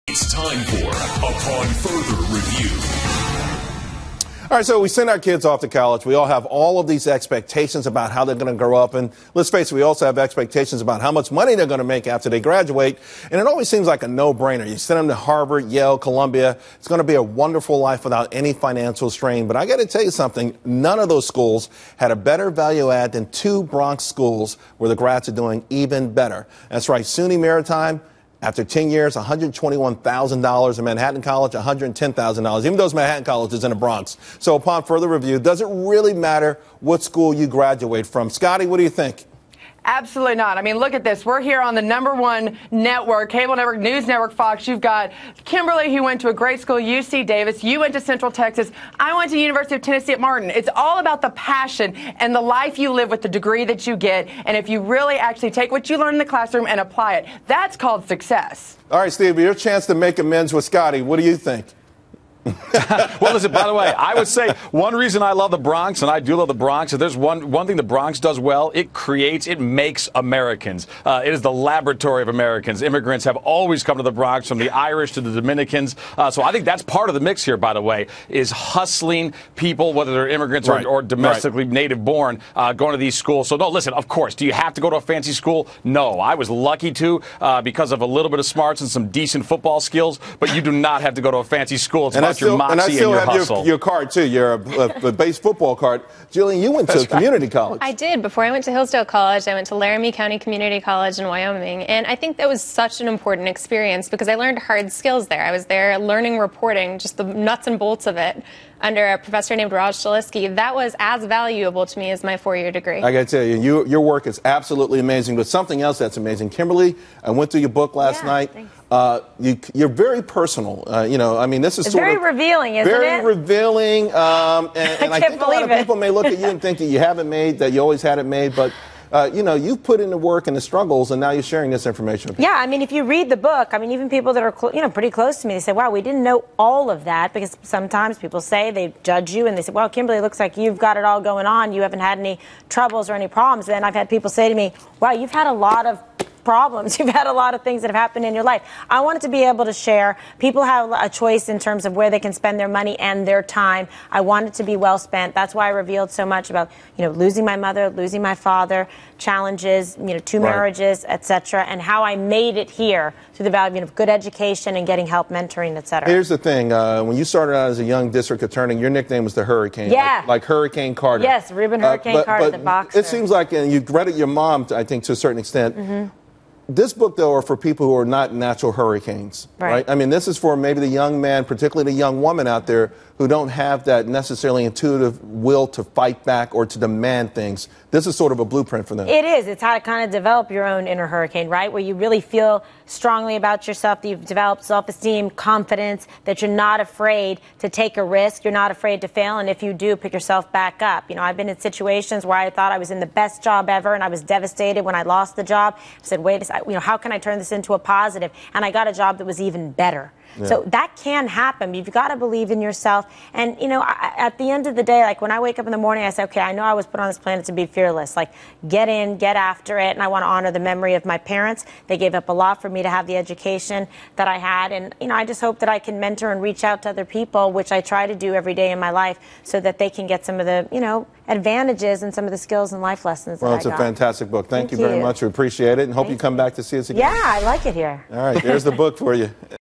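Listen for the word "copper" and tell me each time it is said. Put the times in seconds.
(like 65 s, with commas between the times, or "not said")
not said.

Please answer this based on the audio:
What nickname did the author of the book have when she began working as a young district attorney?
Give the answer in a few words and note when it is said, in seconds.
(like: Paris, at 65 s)
the Hurricane, at 169 s.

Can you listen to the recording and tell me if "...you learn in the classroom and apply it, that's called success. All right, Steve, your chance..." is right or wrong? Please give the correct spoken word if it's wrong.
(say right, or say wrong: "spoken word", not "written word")
right.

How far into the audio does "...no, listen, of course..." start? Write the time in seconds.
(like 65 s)
83 s.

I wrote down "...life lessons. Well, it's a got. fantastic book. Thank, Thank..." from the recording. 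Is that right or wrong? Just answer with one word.
right.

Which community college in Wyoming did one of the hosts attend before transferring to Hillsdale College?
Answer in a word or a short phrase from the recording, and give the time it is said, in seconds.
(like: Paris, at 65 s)
Laramie County Community College, at 99 s.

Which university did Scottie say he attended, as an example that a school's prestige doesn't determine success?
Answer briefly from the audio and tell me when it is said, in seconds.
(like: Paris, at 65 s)
University of Tennessee at Martin, at 49 s.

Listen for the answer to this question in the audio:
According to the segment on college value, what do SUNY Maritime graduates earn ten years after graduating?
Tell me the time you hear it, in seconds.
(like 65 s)
29 s.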